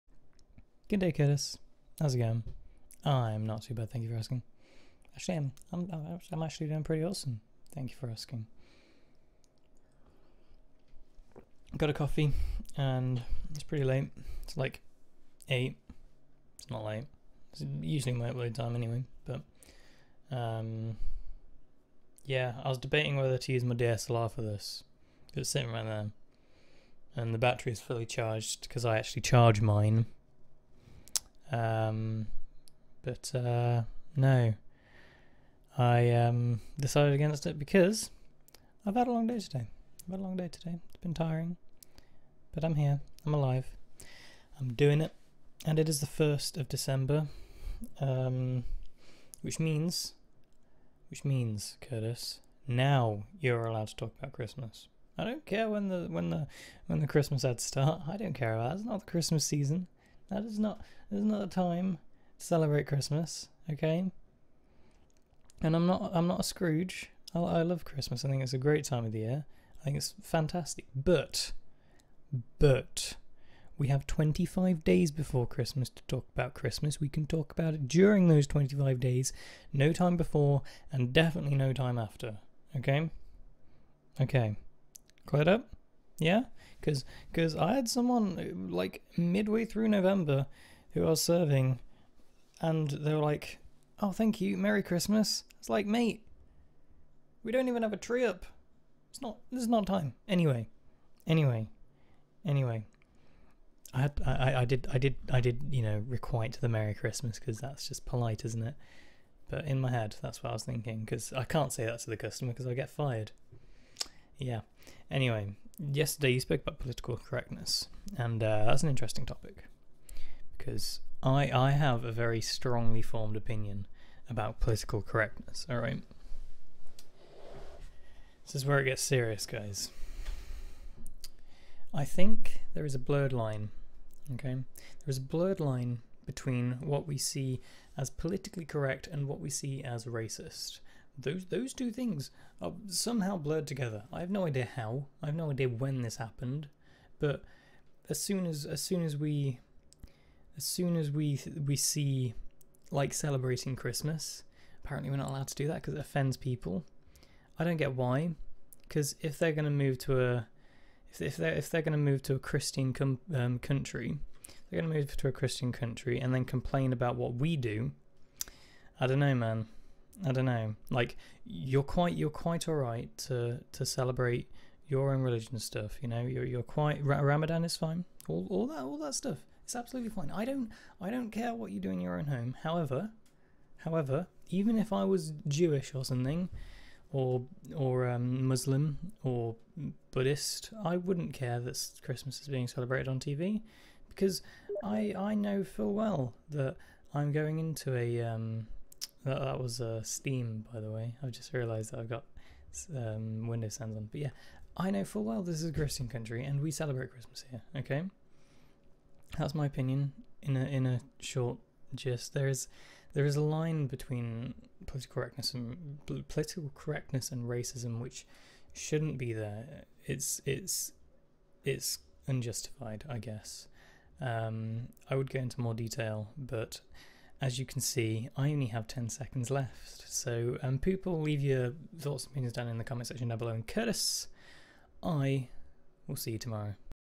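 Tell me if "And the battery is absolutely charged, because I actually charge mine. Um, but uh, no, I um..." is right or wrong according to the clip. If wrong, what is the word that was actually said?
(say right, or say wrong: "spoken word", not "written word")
wrong: "fully", not "absolutely".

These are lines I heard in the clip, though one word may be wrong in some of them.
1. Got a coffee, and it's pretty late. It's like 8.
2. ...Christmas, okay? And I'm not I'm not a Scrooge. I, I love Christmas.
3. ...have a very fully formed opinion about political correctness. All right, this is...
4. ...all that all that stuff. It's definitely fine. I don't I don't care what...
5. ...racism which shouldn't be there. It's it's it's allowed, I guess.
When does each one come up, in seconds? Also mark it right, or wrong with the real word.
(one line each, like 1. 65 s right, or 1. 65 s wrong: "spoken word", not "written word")
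1. 11 s right
2. 62 s right
3. 121 s wrong: "strongly", not "fully"
4. 178 s wrong: "absolutely", not "definitely"
5. 217 s wrong: "unjustified", not "allowed".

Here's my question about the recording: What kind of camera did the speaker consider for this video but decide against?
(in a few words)
DSLR.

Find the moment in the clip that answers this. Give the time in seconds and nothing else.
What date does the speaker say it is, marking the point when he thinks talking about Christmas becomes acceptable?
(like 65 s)
46 s.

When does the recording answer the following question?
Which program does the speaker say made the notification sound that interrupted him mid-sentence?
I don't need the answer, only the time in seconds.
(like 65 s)
200 s.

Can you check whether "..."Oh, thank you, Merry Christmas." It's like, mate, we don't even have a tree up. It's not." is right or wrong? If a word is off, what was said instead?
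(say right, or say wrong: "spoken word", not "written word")
right.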